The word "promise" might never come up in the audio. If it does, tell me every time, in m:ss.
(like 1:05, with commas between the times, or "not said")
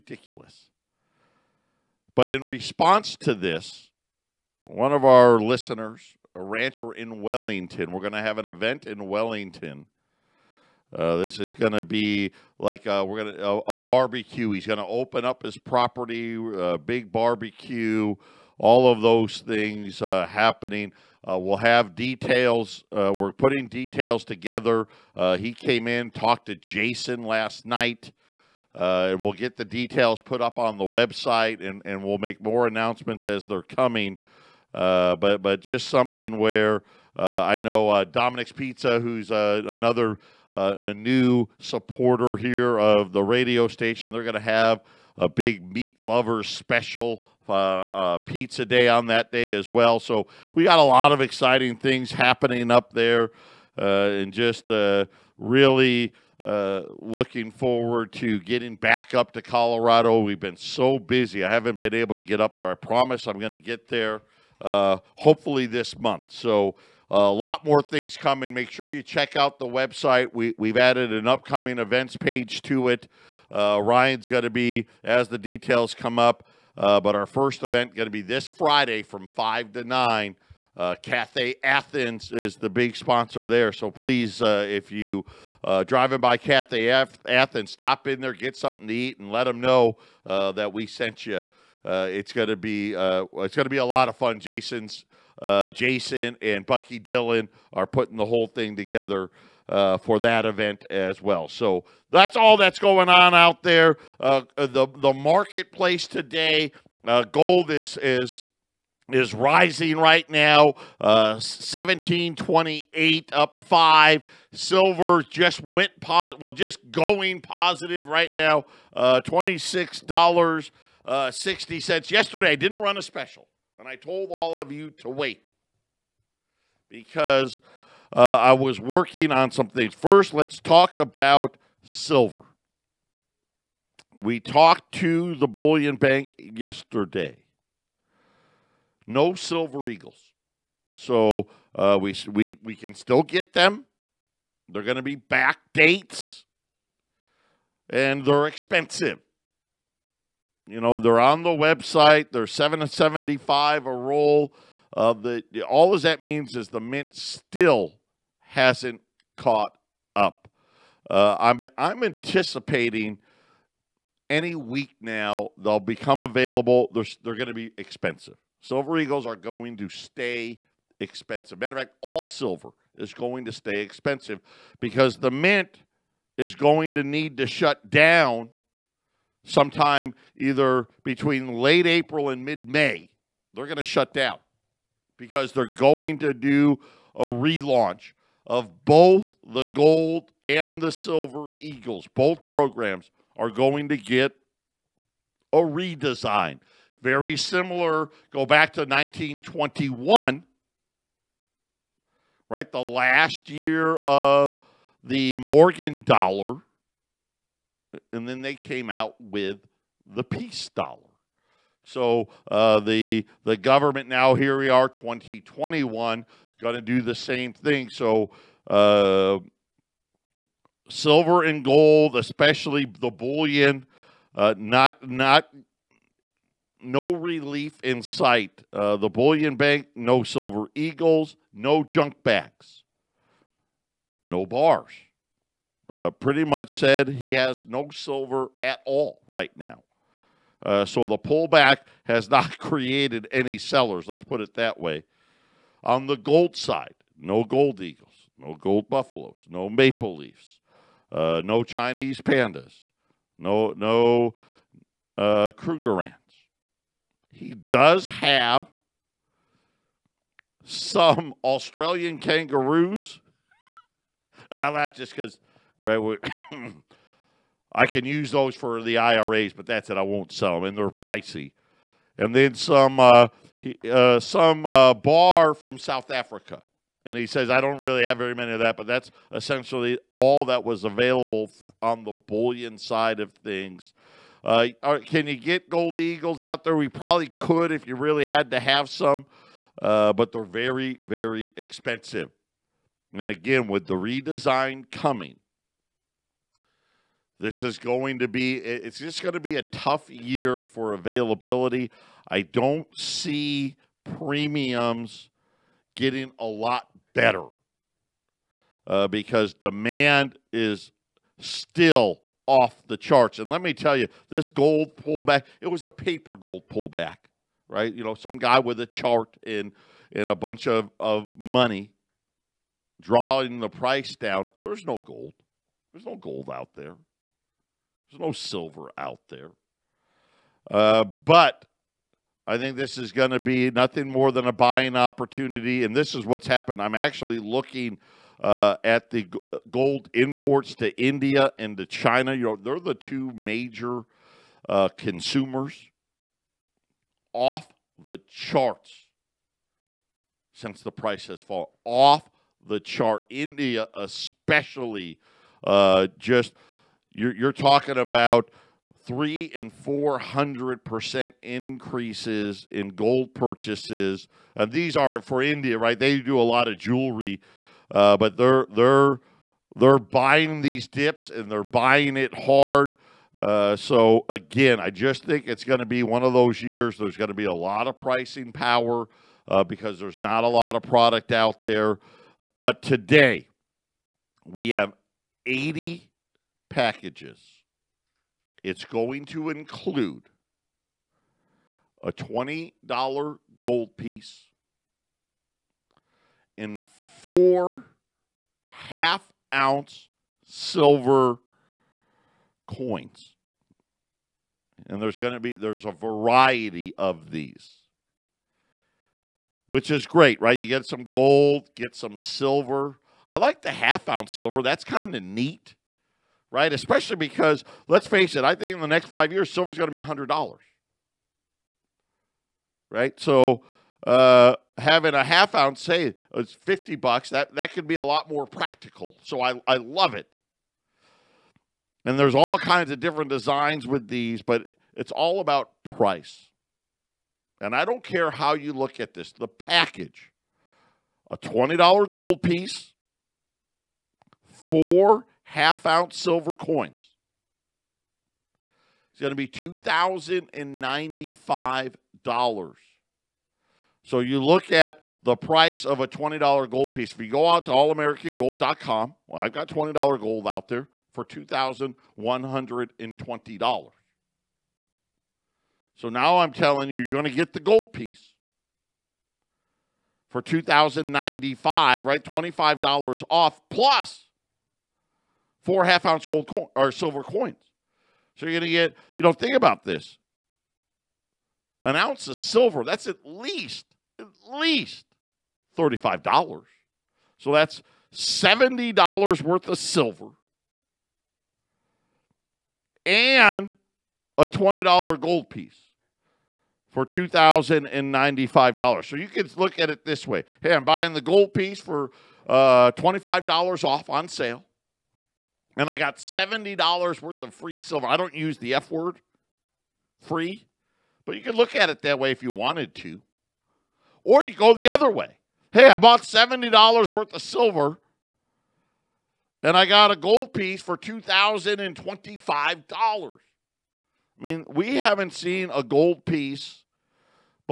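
1:02.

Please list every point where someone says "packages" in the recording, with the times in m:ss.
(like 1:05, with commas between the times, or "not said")
6:26, 7:19.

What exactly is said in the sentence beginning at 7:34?
So you look at the price of a $20 gold piece.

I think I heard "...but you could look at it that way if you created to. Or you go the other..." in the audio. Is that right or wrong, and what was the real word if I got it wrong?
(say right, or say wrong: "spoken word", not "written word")
wrong: "wanted", not "created".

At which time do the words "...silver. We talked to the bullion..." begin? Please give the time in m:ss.
2:11.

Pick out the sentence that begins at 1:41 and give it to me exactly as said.
So that's all that's going on out there.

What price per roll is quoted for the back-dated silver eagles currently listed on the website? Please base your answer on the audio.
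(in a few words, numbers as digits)
$775.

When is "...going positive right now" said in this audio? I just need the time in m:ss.
1:56.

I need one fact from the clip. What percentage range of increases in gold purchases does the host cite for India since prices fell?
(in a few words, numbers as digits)
300 to 400 percent.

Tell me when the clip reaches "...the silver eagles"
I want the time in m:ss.
3:10.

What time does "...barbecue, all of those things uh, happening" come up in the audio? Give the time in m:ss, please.
0:17.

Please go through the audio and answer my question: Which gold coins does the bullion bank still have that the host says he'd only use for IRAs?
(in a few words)
Australian kangaroos.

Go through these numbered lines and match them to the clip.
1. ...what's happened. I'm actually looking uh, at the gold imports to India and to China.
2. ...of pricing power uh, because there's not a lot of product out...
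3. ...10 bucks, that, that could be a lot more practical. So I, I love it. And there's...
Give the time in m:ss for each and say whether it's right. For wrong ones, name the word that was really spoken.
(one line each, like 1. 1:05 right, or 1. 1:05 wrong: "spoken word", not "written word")
1. 5:36 right
2. 6:17 right
3. 7:06 wrong: "50", not "10".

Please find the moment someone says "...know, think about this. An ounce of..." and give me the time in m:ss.
7:59.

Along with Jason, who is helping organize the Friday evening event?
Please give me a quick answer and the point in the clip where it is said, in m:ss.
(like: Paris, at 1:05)
Bucky Dillon, at 1:36.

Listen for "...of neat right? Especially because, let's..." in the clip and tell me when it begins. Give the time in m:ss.
6:55.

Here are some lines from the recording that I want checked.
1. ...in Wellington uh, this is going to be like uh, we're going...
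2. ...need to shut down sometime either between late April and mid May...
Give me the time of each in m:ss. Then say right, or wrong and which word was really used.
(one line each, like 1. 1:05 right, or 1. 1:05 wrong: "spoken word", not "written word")
1. 0:08 right
2. 2:57 right.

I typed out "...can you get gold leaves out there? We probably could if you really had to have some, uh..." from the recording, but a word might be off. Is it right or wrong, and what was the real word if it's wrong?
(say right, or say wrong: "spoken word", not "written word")
wrong: "eagles", not "leaves".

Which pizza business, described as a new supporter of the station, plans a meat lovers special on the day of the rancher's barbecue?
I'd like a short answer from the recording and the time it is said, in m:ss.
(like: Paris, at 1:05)
Dominic's Pizza, at 0:38.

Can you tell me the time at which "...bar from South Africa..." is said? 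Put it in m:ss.
4:34.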